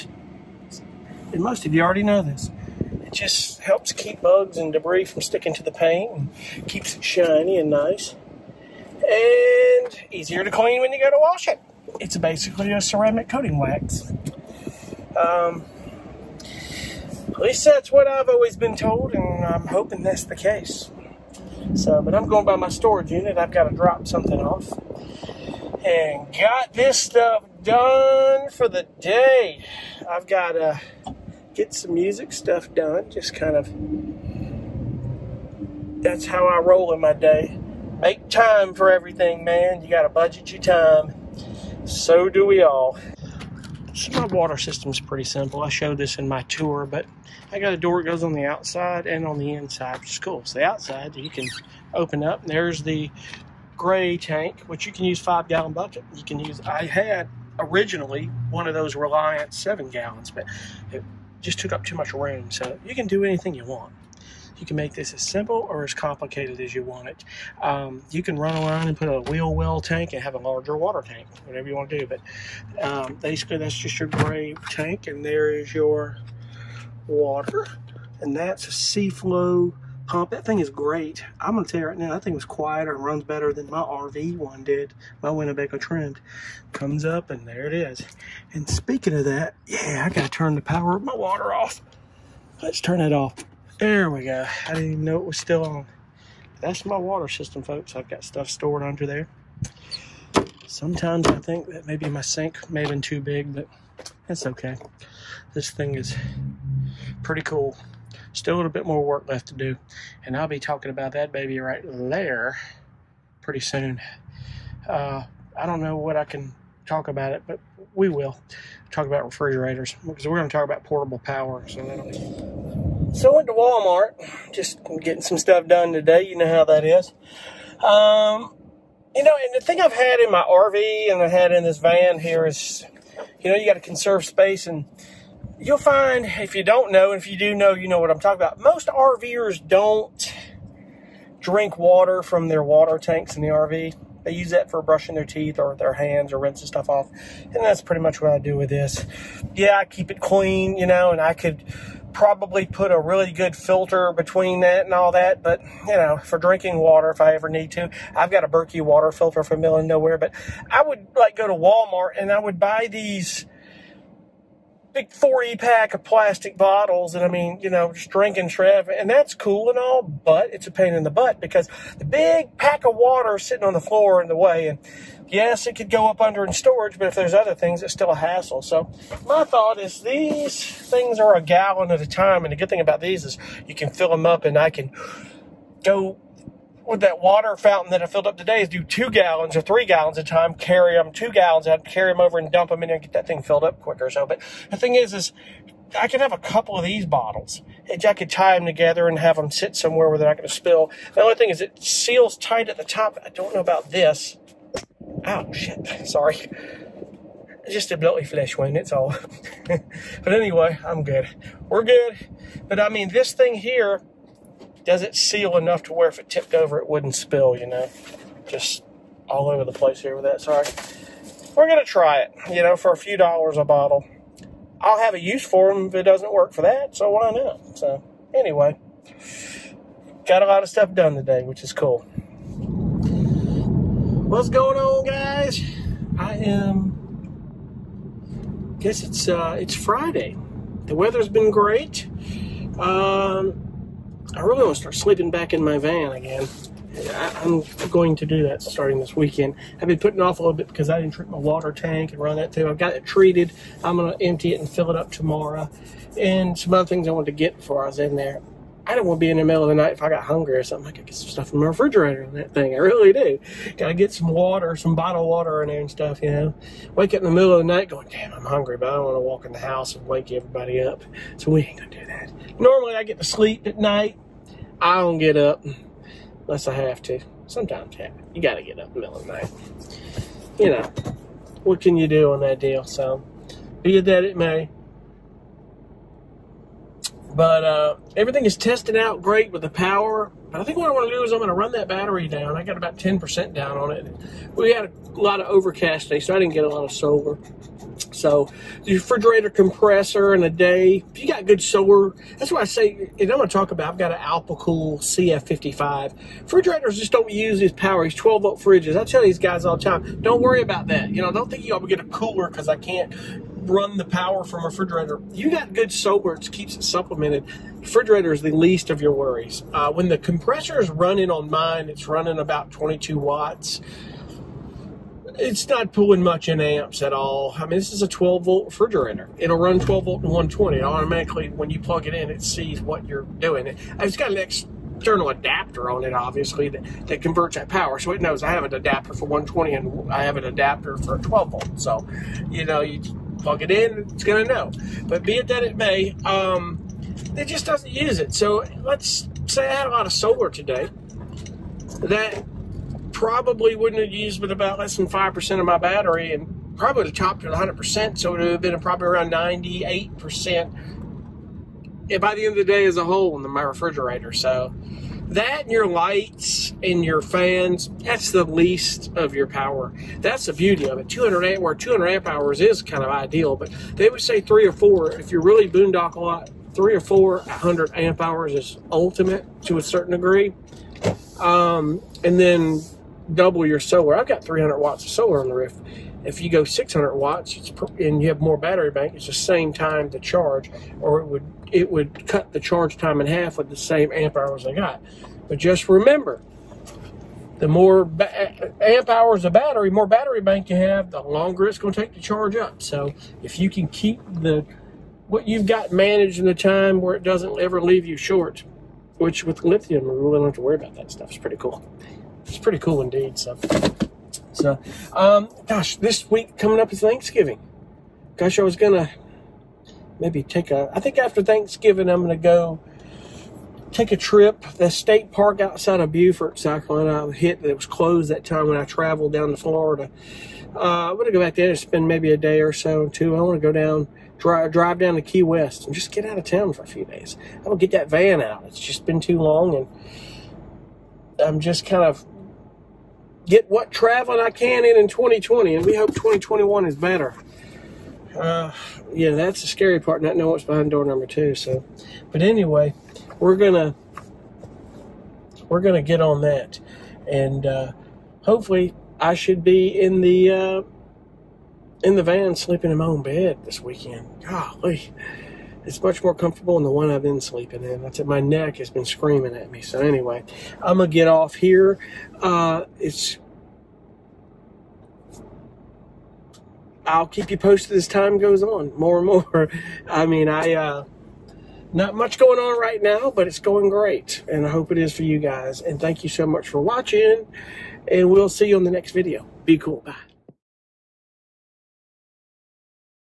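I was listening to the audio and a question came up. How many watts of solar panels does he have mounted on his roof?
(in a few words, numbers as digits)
300 watts.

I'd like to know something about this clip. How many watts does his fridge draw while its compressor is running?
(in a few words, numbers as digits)
22 watts.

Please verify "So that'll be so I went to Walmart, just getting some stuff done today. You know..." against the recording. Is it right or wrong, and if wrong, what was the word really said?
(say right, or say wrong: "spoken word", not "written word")
right.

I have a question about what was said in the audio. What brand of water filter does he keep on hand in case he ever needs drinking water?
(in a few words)
Berkey.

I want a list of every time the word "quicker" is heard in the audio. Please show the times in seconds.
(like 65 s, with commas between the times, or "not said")
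193 s.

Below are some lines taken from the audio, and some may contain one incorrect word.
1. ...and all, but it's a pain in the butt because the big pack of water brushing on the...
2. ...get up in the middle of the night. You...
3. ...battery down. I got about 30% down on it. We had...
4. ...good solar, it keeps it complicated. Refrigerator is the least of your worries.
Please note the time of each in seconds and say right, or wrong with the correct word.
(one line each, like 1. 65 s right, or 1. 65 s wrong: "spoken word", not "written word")
1. 169 s wrong: "sitting", not "brushing"
2. 278 s right
3. 291 s wrong: "10", not "30"
4. 315 s wrong: "supplemented", not "complicated".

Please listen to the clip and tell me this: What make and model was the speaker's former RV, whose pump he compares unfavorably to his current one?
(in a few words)
Winnebago Trend.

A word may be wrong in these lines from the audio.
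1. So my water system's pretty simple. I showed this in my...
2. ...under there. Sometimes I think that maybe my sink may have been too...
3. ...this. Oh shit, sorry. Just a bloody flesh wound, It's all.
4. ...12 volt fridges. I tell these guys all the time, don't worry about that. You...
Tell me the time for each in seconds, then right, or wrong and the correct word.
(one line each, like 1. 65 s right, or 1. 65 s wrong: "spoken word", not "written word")
1. 43 s right
2. 98 s right
3. 203 s right
4. 308 s right.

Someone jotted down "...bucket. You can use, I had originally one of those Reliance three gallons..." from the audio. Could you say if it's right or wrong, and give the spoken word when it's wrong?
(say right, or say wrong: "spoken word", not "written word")
wrong: "seven", not "three".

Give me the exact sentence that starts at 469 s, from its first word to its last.
So anyway, I'm gonna get off here.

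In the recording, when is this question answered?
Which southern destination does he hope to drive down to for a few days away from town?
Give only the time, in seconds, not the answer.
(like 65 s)
435 s.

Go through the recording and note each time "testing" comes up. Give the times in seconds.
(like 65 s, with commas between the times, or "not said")
288 s.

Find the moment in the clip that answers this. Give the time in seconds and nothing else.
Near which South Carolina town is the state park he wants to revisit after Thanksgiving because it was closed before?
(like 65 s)
426 s.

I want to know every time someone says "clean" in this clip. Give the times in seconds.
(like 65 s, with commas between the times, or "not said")
10 s, 150 s.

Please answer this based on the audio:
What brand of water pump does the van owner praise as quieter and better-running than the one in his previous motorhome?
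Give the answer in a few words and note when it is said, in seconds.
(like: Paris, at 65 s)
Seaflo, at 78 s.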